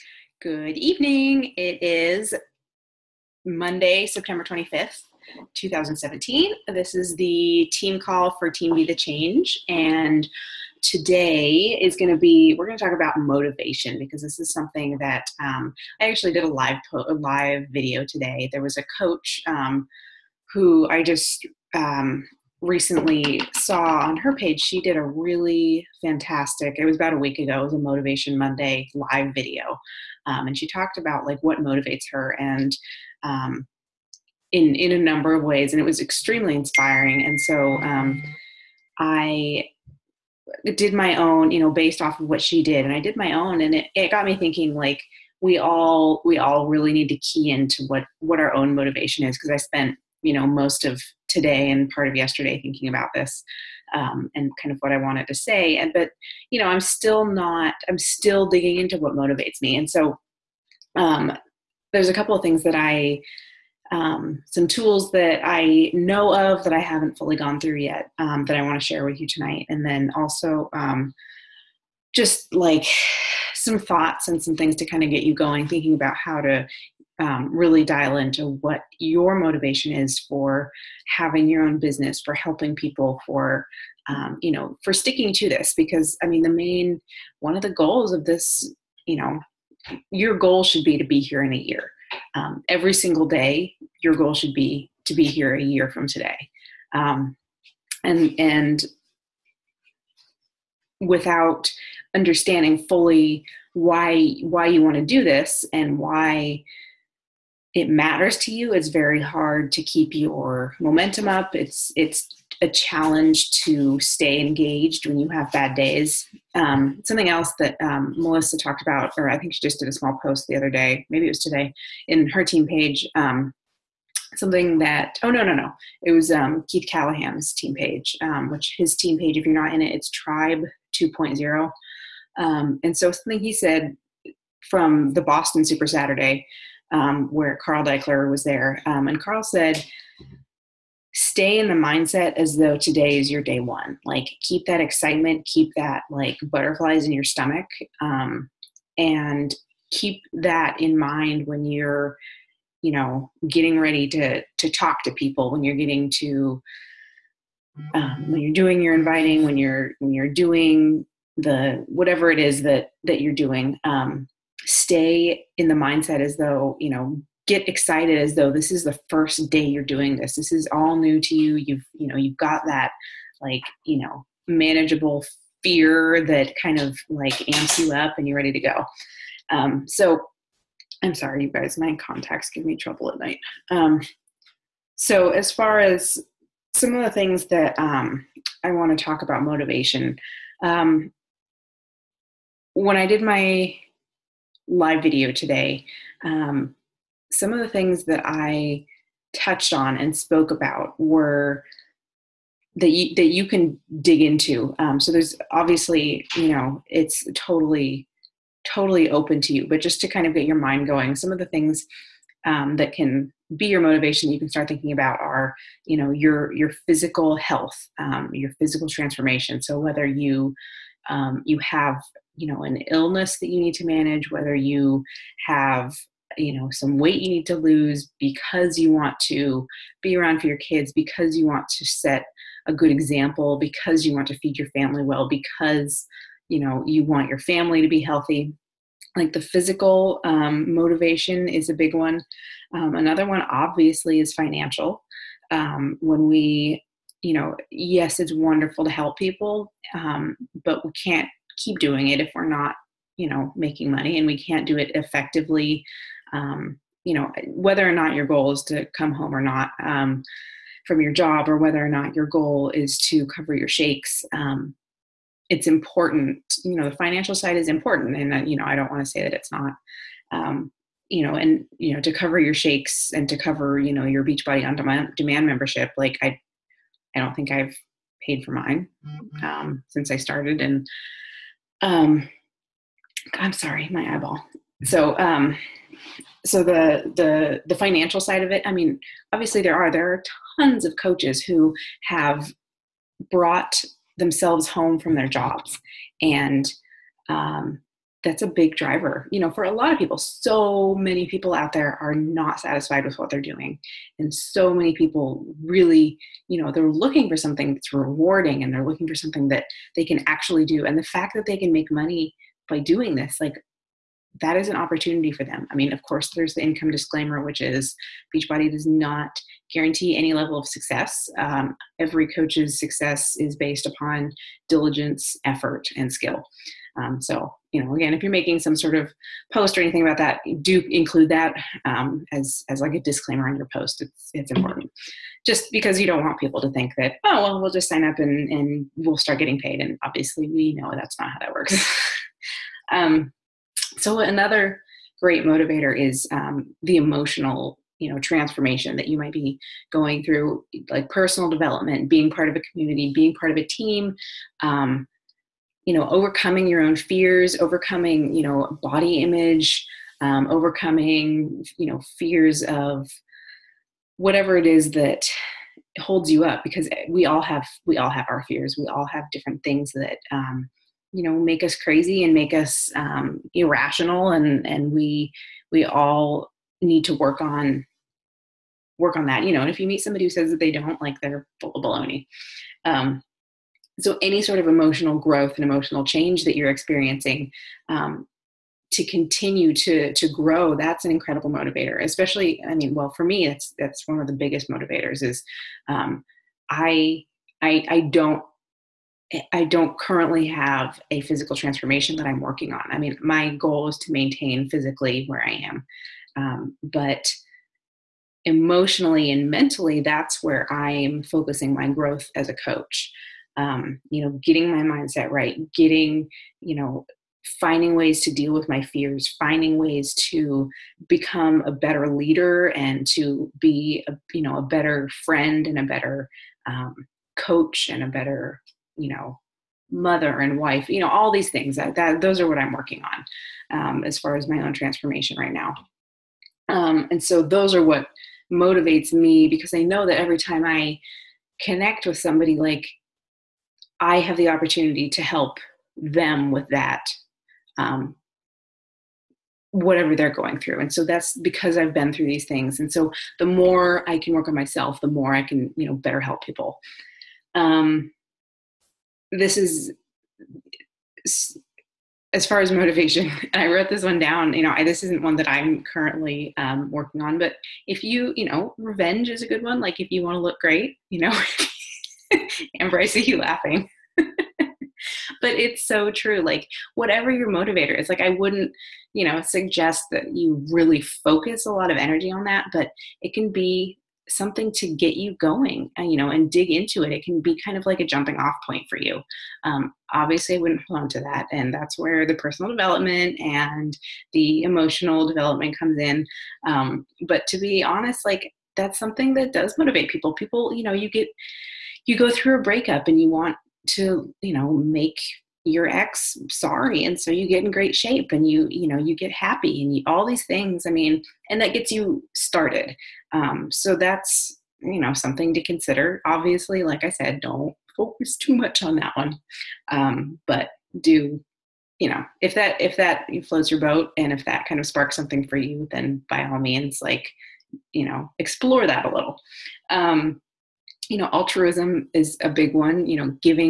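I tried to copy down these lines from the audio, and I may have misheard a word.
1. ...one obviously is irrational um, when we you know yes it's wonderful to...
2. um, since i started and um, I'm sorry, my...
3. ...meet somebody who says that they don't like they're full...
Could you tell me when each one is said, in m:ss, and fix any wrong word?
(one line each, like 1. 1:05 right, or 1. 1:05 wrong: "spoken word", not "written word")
1. 4:03 wrong: "financial", not "irrational"
2. 4:39 right
3. 6:19 right.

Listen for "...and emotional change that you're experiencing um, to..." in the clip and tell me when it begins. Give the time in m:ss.
6:25.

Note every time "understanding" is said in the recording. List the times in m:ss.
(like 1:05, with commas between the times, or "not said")
1:42.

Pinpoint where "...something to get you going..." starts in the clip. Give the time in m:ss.
8:04.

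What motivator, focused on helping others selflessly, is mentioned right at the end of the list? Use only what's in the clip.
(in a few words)
altruism.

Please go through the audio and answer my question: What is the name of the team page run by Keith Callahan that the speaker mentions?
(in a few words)
Tribe 2.0.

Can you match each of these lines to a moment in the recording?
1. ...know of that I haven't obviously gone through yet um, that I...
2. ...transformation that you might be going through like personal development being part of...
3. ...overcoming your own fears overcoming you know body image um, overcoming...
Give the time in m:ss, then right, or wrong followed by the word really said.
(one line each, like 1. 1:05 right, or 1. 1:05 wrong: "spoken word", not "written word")
1. 1:05 wrong: "fully", not "obviously"
2. 5:48 right
3. 5:56 right.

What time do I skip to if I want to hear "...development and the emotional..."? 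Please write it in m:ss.
8:12.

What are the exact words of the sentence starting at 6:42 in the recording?
I mean, my goal is to maintain physically where I am.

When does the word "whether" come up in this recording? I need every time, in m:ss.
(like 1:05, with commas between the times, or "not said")
3:39, 3:44, 4:17, 4:21.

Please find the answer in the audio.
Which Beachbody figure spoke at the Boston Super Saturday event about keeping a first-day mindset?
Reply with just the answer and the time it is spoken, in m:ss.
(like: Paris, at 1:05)
Carl Daikeler, at 2:17.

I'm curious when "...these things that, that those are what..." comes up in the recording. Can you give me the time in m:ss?
7:11.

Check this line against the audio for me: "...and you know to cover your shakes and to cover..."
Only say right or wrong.
right.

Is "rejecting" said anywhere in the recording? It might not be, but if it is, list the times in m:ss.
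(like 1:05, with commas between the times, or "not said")
not said.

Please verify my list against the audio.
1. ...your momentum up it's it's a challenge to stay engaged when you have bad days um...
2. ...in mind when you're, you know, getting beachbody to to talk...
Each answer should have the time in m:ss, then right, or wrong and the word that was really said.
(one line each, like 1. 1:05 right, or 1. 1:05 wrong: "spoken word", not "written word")
1. 1:50 right
2. 2:30 wrong: "ready", not "beachbody".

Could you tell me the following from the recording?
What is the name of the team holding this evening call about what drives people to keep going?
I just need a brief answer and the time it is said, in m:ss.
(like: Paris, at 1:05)
Be the Change, at 0:08.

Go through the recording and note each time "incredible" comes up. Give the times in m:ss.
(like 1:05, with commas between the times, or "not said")
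6:31.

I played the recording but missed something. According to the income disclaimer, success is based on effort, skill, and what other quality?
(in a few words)
diligence.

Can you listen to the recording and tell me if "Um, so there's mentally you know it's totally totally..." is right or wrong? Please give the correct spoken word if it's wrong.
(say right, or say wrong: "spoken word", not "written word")
wrong: "obviously", not "mentally".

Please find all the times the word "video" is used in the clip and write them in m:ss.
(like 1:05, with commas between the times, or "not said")
0:17, 0:29, 3:15.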